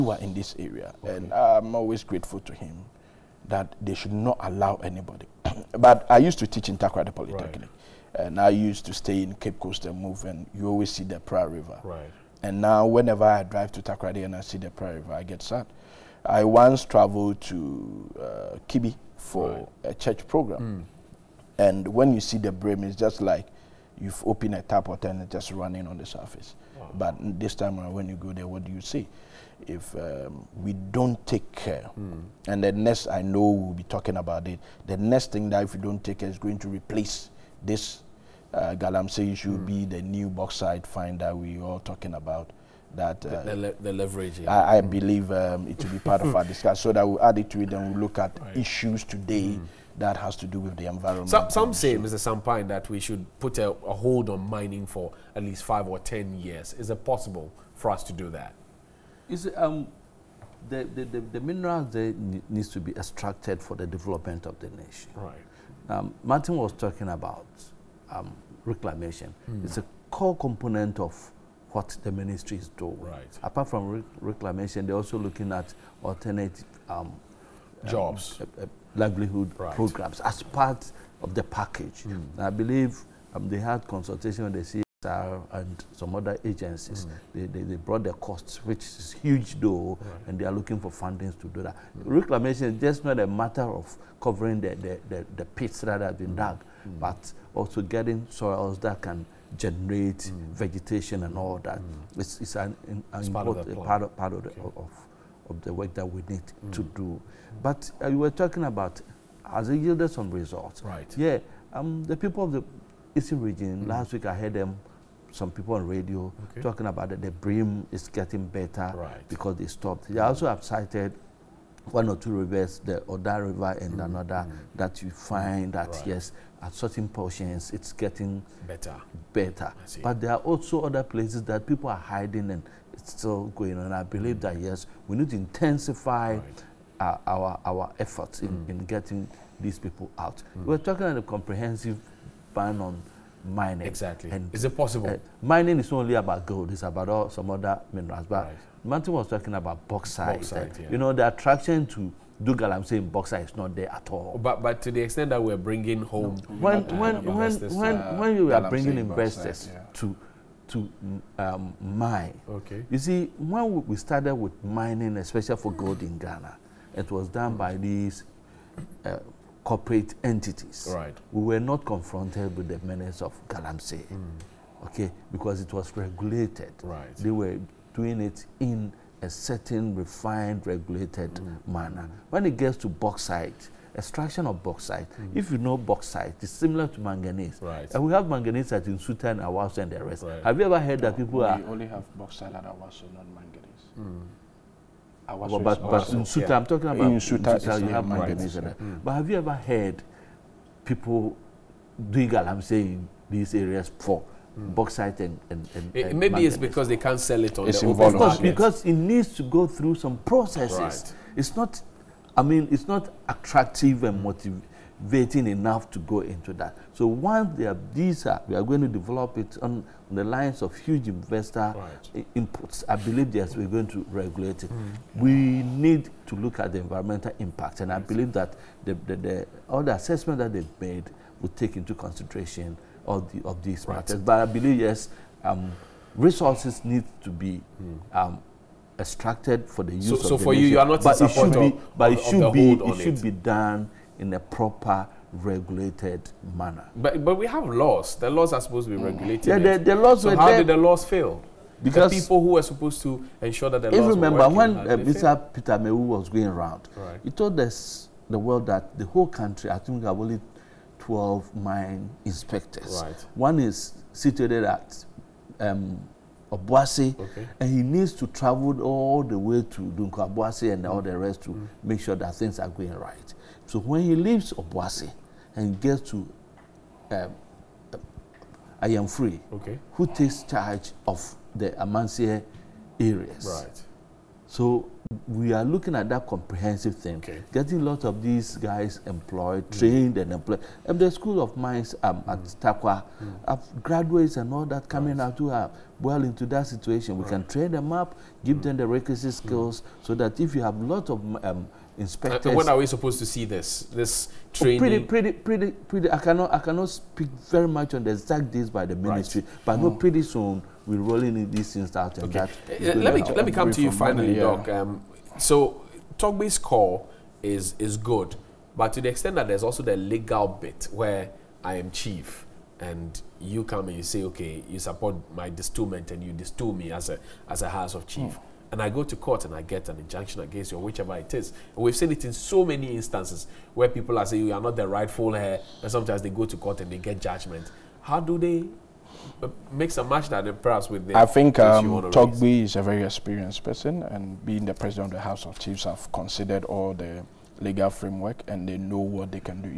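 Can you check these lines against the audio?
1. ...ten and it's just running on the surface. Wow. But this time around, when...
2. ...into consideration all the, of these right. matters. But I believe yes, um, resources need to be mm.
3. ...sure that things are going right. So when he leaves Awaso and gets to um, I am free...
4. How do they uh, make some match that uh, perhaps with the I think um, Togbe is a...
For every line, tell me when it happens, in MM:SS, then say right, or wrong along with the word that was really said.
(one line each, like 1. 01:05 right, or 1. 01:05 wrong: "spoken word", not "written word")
1. 00:24 right
2. 03:51 right
3. 04:32 wrong: "Obuasi", not "Awaso"
4. 05:38 right.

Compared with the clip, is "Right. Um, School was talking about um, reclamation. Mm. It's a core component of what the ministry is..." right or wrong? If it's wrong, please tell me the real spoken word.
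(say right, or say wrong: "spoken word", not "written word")
wrong: "Martin", not "School".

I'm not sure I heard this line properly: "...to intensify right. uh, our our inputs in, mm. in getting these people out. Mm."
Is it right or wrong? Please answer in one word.
wrong.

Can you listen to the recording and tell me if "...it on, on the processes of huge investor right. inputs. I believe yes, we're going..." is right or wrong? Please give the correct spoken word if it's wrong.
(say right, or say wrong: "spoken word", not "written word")
wrong: "lines", not "processes".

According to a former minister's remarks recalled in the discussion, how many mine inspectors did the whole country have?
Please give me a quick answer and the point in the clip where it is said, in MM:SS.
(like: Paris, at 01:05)
12, at 04:20.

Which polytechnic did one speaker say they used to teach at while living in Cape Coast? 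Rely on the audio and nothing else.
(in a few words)
Takrada Polytechnic.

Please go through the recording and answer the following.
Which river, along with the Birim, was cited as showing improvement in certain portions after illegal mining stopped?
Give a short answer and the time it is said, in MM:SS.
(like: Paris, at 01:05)
Oda River, at 02:02.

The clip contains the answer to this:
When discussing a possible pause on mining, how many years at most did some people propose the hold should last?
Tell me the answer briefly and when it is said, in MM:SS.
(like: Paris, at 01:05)
10, at 00:55.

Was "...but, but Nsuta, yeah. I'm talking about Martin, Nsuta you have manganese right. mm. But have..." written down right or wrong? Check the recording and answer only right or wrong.
wrong.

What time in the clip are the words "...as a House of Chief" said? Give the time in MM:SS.
05:27.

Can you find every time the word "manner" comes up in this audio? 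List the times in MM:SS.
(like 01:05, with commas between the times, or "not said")
03:01, 04:06.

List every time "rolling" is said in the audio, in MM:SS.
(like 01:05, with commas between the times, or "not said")
05:10.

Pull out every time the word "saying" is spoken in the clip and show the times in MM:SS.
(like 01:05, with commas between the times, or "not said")
02:32, 03:22, 05:34.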